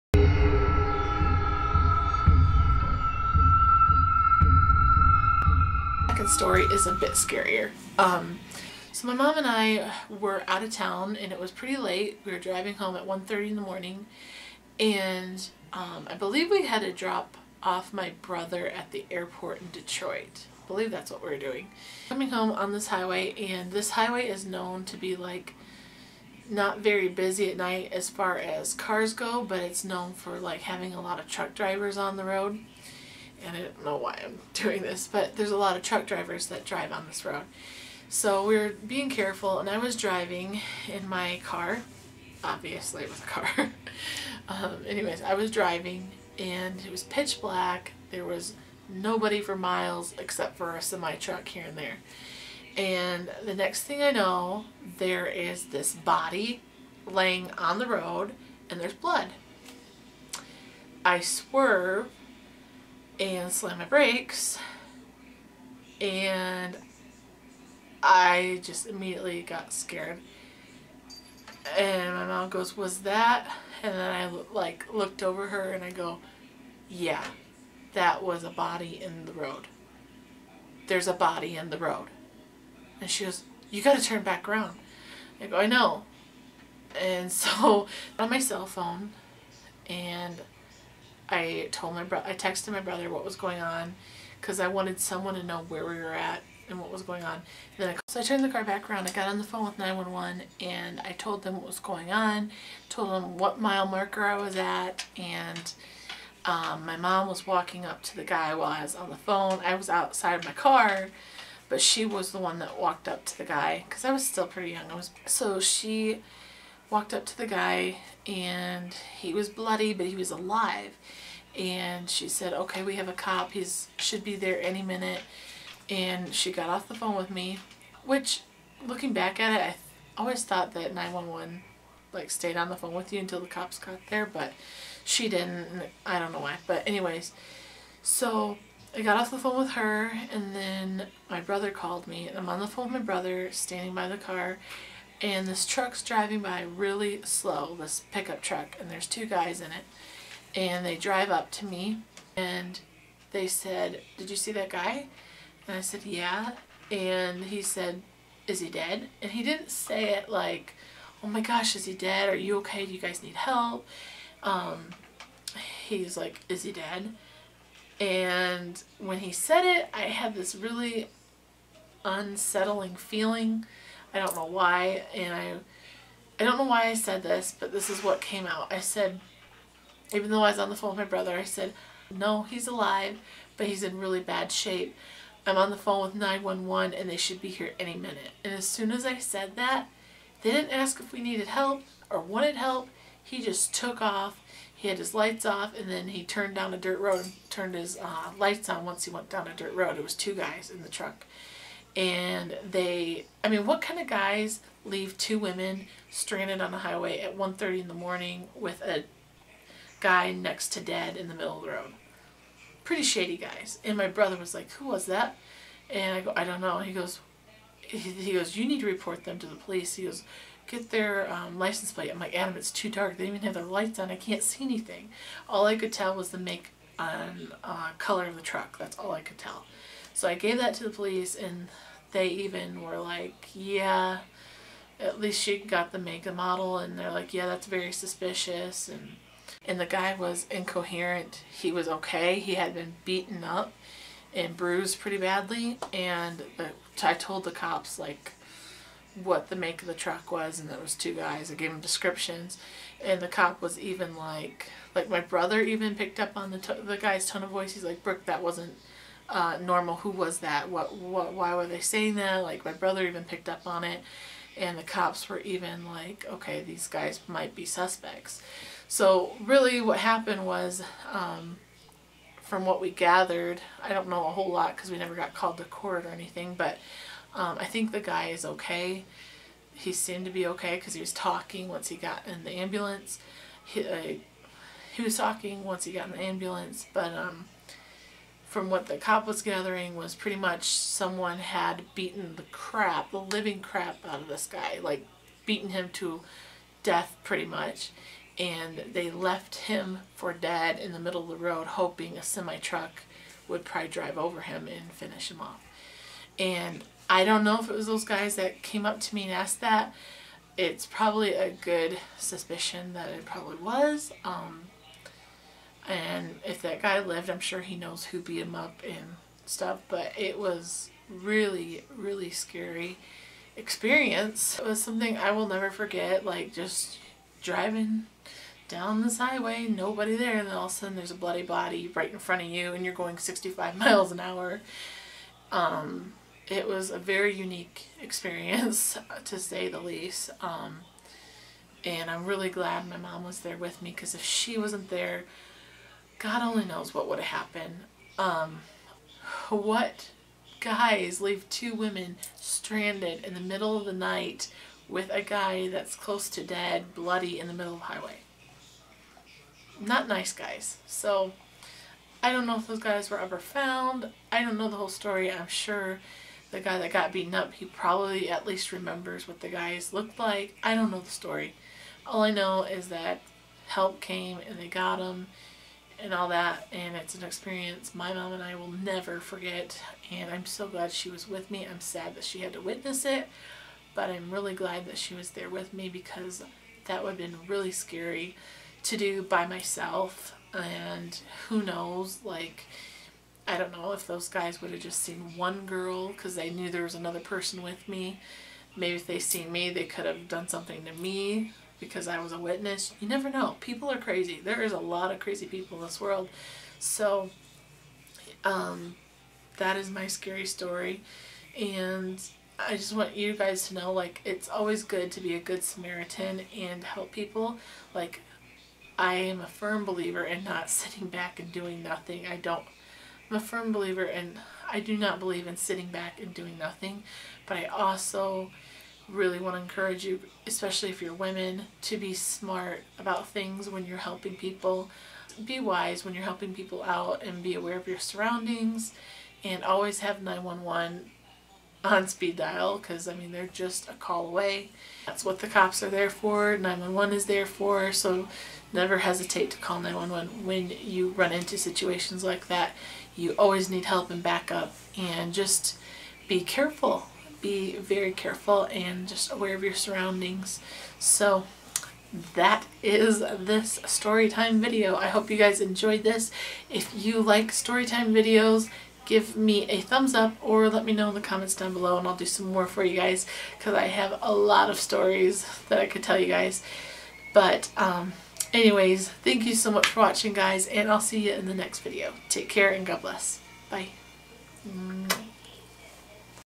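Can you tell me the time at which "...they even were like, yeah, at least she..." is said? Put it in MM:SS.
03:52.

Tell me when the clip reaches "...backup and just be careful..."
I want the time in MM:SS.
07:34.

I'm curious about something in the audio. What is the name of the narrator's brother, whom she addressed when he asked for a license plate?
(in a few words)
Adam.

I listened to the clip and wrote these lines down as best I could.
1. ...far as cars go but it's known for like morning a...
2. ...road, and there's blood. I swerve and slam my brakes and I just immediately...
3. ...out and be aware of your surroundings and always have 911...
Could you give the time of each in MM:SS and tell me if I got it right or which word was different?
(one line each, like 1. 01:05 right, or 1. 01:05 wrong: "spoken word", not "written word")
1. 00:28 wrong: "having", not "morning"
2. 00:57 right
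3. 07:16 right.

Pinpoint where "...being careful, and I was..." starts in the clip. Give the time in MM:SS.
00:38.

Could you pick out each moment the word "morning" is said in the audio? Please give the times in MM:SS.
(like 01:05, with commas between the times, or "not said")
00:13, 03:27.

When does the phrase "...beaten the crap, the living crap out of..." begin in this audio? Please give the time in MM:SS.
04:51.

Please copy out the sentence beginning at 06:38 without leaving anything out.
Maybe if they seen me they could have done something to me because I was a witness.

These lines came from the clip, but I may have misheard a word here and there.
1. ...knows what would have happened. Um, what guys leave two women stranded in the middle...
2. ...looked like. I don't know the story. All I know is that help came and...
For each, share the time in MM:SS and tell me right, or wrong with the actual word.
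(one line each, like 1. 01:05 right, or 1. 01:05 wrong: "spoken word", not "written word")
1. 05:46 right
2. 06:09 right.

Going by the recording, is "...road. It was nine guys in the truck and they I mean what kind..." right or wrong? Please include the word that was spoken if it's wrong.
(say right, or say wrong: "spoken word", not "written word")
wrong: "two", not "nine".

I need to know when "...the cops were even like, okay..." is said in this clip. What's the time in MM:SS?
04:24.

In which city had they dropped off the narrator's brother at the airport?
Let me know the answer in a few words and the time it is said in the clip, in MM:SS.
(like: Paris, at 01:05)
Detroit, at 00:19.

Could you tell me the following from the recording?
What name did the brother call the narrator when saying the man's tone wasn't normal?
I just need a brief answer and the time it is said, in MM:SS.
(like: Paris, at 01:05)
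Brooke, at 04:18.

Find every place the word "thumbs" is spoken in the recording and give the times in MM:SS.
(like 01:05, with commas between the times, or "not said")
07:49.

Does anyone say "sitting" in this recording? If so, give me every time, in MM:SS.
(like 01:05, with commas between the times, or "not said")
07:00, 07:05.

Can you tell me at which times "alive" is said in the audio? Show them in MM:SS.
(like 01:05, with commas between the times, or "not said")
02:00, 03:02.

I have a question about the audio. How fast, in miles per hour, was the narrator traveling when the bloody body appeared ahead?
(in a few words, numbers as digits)
65.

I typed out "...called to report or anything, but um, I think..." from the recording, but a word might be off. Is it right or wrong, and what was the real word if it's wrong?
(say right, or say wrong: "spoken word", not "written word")
wrong: "court", not "report".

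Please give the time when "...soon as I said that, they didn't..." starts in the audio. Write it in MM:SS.
03:08.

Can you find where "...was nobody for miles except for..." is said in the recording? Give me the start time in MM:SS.
00:48.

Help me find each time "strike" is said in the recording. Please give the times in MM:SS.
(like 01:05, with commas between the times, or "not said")
not said.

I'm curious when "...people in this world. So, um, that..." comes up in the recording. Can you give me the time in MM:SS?
06:45.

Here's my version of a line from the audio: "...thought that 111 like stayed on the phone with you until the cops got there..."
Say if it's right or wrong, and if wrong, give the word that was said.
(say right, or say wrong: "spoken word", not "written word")
wrong: "911", not "111".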